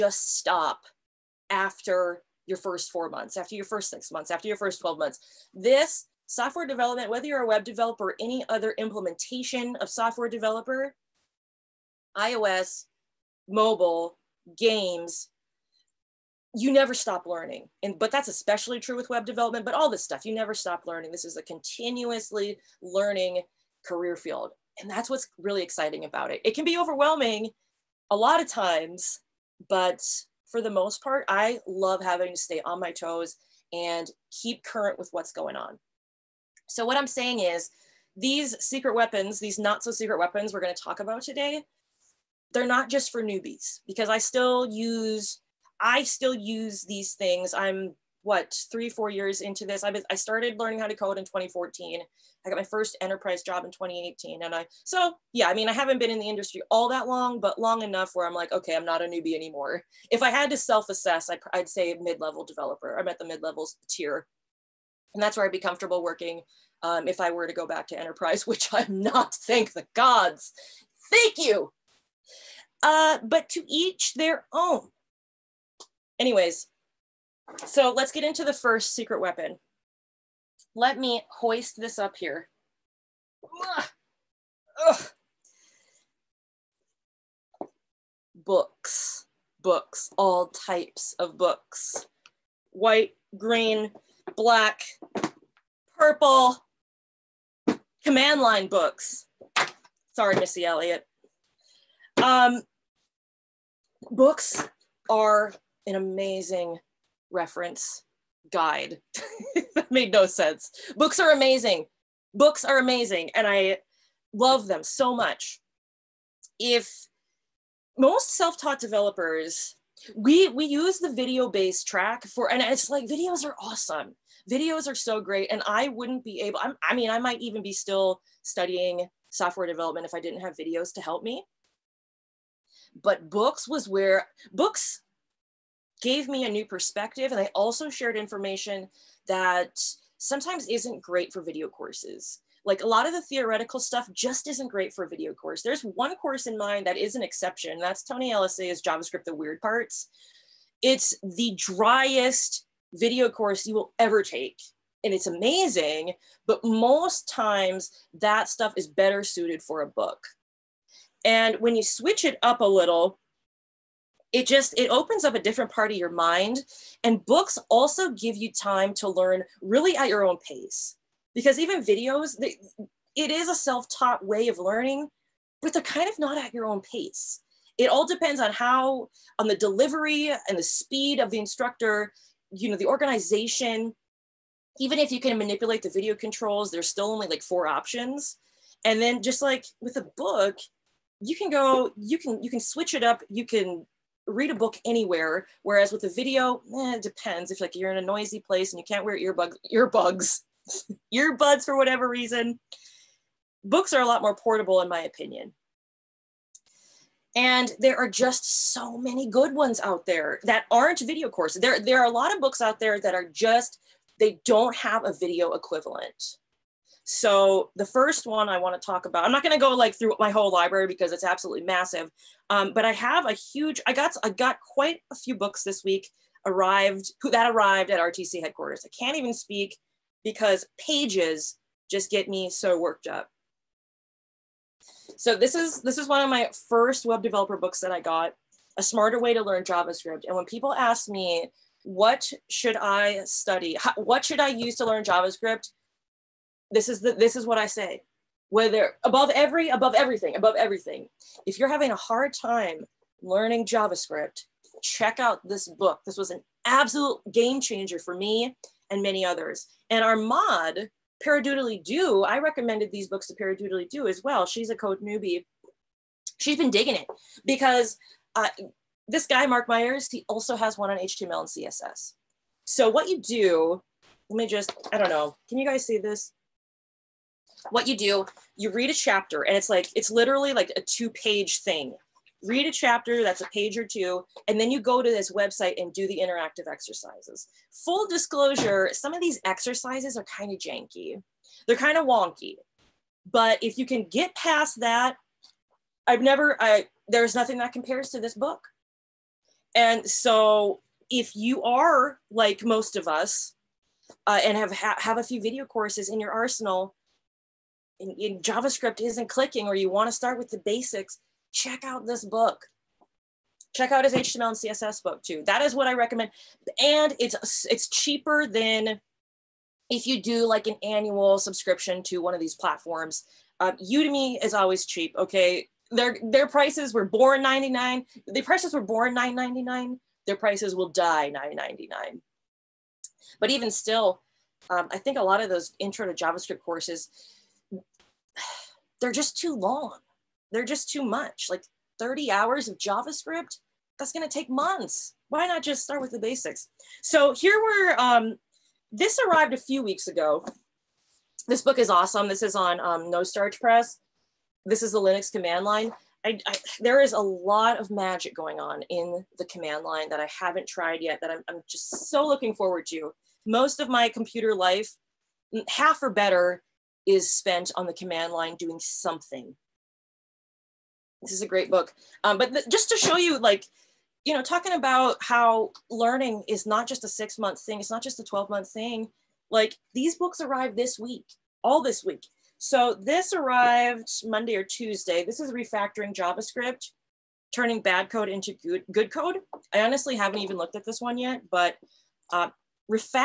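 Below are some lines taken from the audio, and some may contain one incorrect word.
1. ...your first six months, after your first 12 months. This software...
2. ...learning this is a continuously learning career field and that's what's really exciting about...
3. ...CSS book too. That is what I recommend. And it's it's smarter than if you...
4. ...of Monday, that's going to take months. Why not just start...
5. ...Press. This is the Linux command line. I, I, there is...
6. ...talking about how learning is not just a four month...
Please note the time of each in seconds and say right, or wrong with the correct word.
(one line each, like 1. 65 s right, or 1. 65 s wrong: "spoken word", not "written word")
1. 3 s right
2. 20 s right
3. 314 s wrong: "cheaper", not "smarter"
4. 342 s wrong: "JavaScript", not "Monday"
5. 353 s right
6. 374 s wrong: "six", not "four".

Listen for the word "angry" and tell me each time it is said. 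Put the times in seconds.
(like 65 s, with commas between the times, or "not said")
not said.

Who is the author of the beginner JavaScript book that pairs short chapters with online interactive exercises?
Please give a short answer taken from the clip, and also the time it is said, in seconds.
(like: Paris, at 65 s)
Mark Myers, at 269 s.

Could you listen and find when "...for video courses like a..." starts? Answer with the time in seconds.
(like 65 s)
141 s.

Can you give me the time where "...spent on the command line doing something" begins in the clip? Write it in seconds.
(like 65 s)
367 s.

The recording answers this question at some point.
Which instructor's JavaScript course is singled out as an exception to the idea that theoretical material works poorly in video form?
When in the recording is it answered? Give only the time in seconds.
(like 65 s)
148 s.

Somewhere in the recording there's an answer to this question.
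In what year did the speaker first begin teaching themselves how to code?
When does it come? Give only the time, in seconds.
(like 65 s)
51 s.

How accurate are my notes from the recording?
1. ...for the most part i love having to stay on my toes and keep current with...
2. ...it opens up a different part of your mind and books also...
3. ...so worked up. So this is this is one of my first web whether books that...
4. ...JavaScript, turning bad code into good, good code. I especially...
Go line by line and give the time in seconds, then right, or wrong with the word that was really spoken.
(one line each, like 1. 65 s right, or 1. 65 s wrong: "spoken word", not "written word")
1. 30 s right
2. 164 s right
3. 232 s wrong: "developer", not "whether"
4. 386 s wrong: "honestly", not "especially".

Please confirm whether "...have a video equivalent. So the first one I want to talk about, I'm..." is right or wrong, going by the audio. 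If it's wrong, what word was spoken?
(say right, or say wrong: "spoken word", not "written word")
right.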